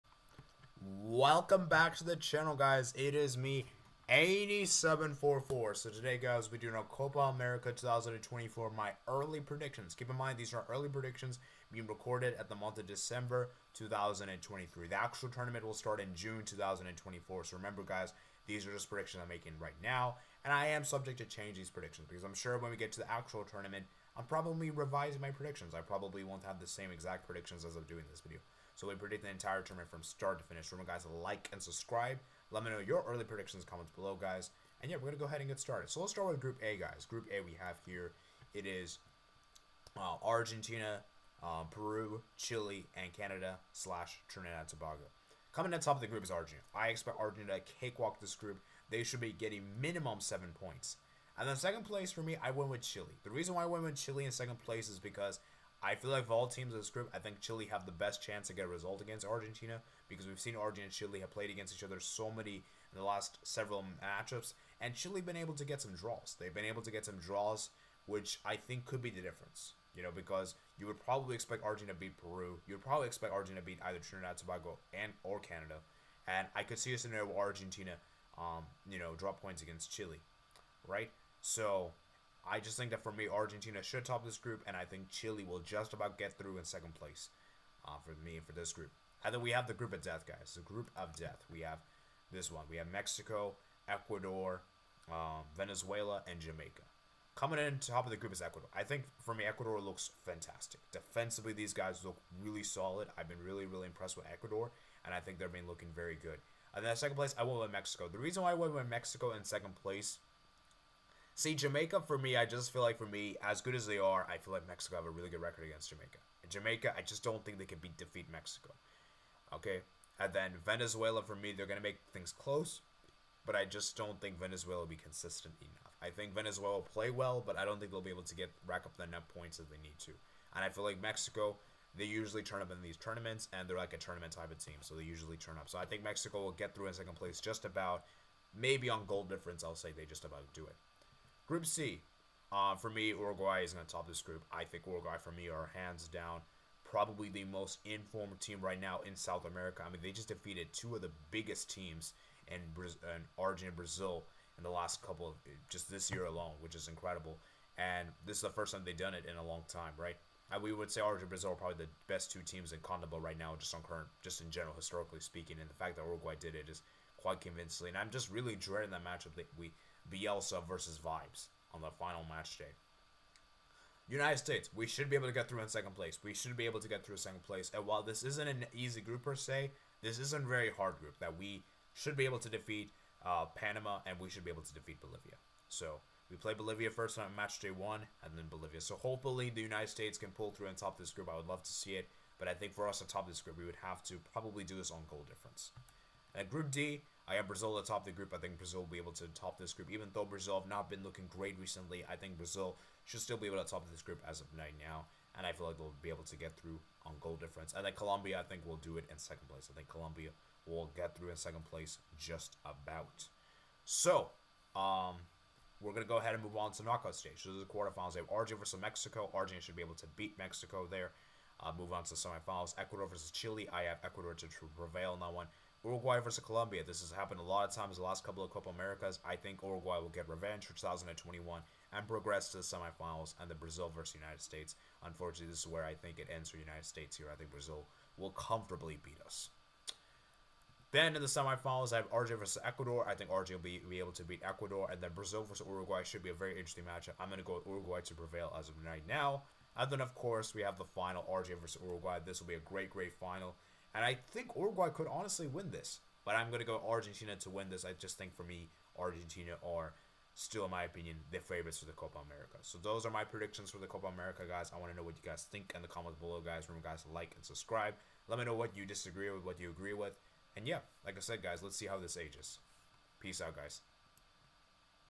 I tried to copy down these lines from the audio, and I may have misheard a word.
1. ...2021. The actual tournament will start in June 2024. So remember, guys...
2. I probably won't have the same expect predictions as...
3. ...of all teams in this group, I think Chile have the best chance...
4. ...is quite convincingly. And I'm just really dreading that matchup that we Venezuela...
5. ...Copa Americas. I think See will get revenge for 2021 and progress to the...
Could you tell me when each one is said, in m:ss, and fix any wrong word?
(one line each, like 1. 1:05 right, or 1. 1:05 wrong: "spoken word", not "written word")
1. 0:13 wrong: "2023", not "2021"
2. 0:25 wrong: "exact", not "expect"
3. 0:56 right
4. 2:46 wrong: "Bielsa", not "Venezuela"
5. 3:48 wrong: "Uruguay", not "See".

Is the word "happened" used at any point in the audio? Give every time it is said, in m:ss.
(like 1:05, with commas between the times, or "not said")
3:47.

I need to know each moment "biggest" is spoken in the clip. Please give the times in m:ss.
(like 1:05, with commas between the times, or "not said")
2:31.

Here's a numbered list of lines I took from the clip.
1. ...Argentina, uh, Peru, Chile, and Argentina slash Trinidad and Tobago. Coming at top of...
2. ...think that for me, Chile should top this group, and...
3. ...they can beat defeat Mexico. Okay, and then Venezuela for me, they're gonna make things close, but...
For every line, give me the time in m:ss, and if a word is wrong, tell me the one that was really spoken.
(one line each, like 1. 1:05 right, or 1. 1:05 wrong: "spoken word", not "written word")
1. 0:40 wrong: "Canada", not "Argentina"
2. 1:22 wrong: "Argentina", not "Chile"
3. 1:57 right.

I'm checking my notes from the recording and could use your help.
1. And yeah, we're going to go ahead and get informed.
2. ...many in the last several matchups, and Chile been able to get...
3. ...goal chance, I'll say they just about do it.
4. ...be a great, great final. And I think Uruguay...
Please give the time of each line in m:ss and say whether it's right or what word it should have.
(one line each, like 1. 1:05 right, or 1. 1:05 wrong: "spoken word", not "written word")
1. 0:34 wrong: "started", not "informed"
2. 1:02 right
3. 2:19 wrong: "difference", not "chance"
4. 4:12 right.